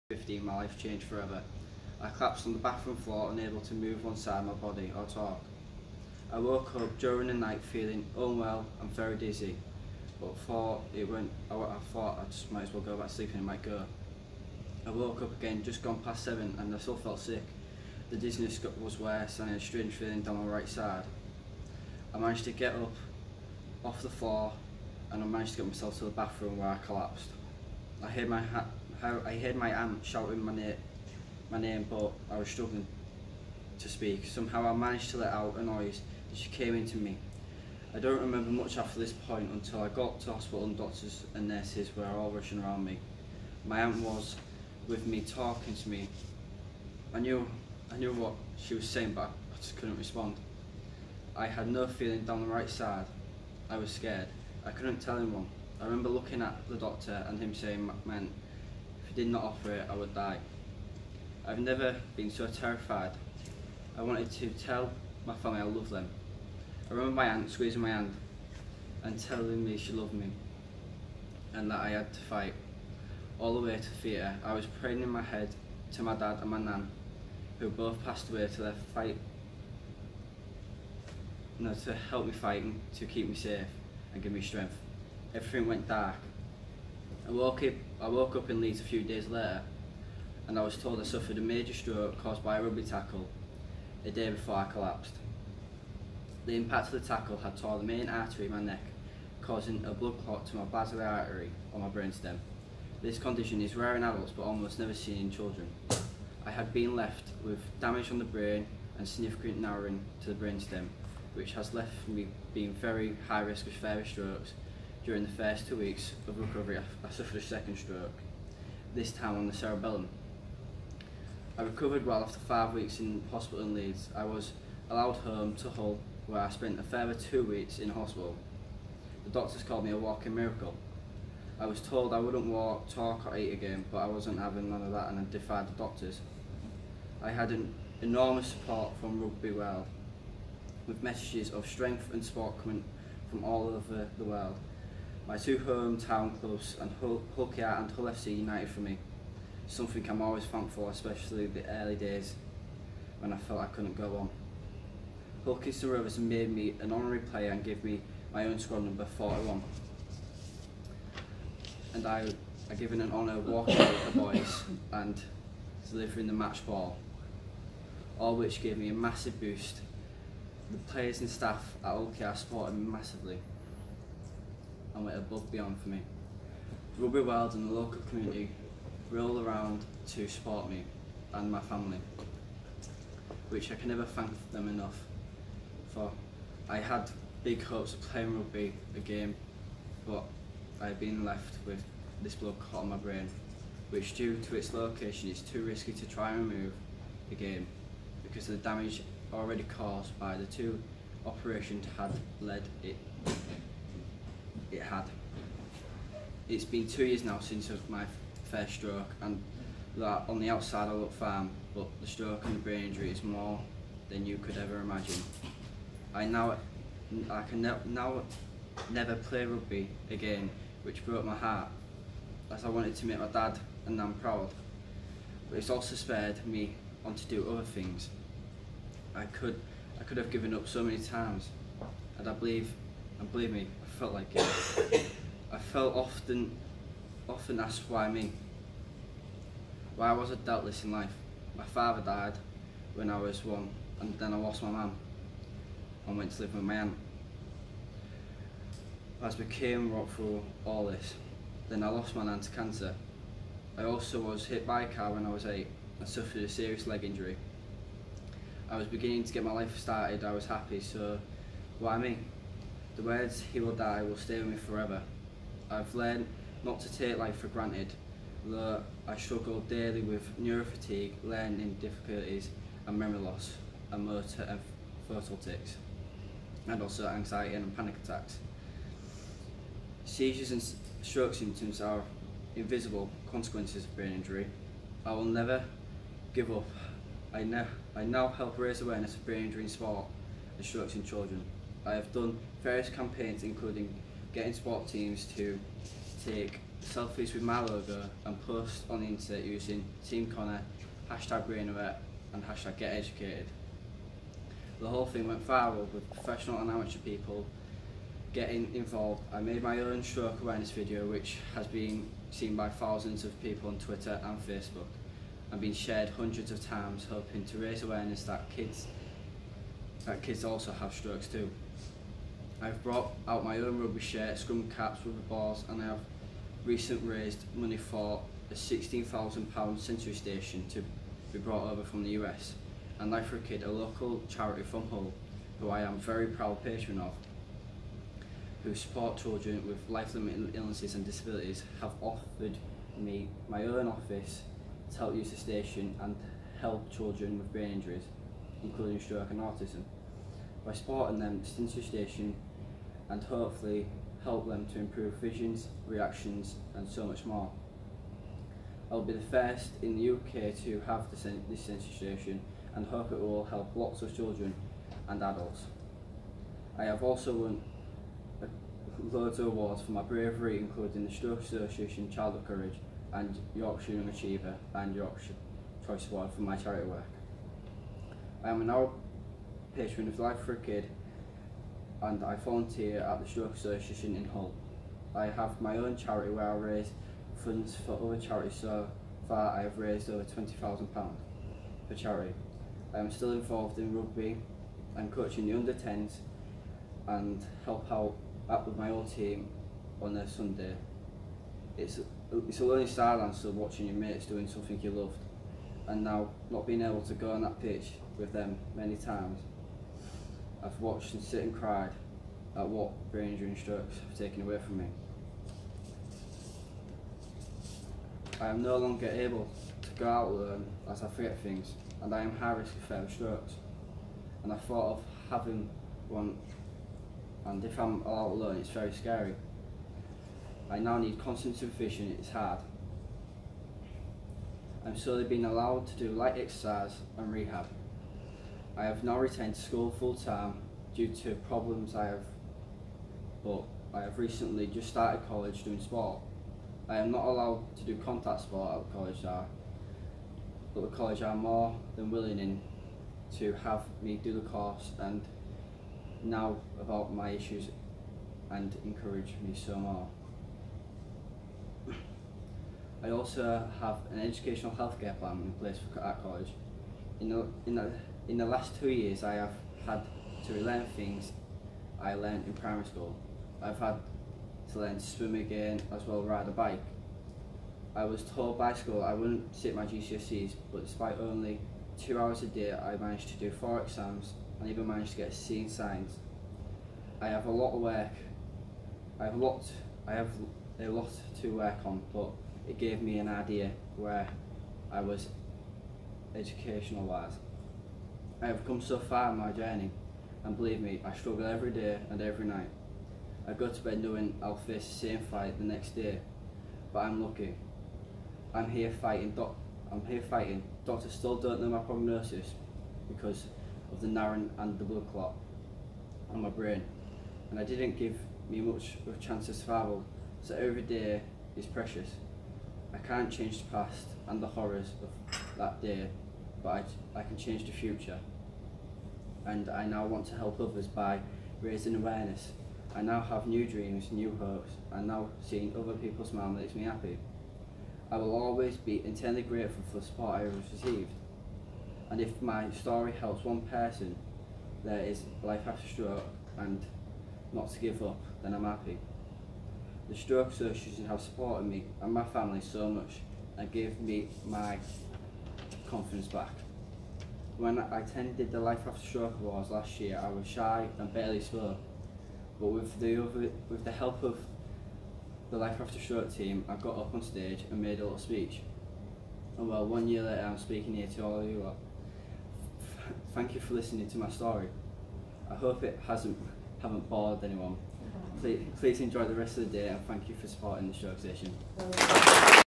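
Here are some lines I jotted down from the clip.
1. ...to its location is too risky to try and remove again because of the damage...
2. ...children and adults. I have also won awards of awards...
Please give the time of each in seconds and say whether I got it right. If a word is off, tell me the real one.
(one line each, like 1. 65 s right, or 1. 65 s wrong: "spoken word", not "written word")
1. 194 s right
2. 364 s wrong: "loads", not "awards".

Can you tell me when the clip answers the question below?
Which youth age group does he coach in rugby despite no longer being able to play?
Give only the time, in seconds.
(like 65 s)
395 s.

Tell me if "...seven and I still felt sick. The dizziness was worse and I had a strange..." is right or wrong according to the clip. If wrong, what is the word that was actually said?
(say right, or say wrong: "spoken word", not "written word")
right.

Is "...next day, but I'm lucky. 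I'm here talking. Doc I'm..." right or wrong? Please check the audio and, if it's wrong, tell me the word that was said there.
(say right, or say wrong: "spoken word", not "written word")
wrong: "fighting", not "talking".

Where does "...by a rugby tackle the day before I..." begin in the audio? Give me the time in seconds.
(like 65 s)
92 s.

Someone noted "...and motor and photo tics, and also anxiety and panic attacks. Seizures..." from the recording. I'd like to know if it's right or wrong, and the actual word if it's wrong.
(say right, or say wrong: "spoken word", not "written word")
right.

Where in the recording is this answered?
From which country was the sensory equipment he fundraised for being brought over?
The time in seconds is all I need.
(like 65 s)
332 s.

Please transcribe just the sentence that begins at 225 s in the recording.
But it's also spared me on to do other things.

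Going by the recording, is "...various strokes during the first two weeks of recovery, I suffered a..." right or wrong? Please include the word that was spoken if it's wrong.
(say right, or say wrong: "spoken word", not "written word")
right.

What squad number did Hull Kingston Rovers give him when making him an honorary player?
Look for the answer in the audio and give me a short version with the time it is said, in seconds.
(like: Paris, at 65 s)
41, at 159 s.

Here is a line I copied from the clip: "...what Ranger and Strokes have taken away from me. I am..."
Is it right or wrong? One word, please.
right.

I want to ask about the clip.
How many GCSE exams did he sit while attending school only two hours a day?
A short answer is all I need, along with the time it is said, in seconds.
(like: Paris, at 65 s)
4, at 483 s.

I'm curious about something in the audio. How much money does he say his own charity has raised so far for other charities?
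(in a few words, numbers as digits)
over £20,000.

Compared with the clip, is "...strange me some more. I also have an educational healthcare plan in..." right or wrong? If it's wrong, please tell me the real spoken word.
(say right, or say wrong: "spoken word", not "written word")
wrong: "encourage", not "strange".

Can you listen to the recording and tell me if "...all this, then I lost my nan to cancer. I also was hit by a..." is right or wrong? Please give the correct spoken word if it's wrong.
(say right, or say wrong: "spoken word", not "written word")
right.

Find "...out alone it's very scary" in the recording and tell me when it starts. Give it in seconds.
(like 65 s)
428 s.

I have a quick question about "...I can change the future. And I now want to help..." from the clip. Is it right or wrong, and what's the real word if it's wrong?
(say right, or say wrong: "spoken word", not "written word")
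right.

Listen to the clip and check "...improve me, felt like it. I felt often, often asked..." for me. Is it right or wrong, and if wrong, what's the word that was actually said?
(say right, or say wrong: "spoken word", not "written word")
wrong: "believe", not "improve".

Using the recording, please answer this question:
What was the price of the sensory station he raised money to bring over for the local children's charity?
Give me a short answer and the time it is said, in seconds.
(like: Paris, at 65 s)
£16,000, at 328 s.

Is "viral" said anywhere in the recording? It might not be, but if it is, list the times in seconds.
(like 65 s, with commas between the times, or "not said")
305 s.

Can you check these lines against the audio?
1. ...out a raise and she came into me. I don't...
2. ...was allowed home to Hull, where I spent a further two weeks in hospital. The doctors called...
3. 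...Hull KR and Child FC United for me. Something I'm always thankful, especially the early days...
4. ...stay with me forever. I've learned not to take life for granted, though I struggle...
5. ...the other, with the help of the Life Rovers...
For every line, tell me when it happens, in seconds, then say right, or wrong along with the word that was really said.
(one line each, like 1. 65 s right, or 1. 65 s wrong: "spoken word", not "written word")
1. 35 s wrong: "noise", not "raise"
2. 124 s right
3. 147 s wrong: "Hull", not "Child"
4. 264 s right
5. 562 s wrong: "After", not "Rovers".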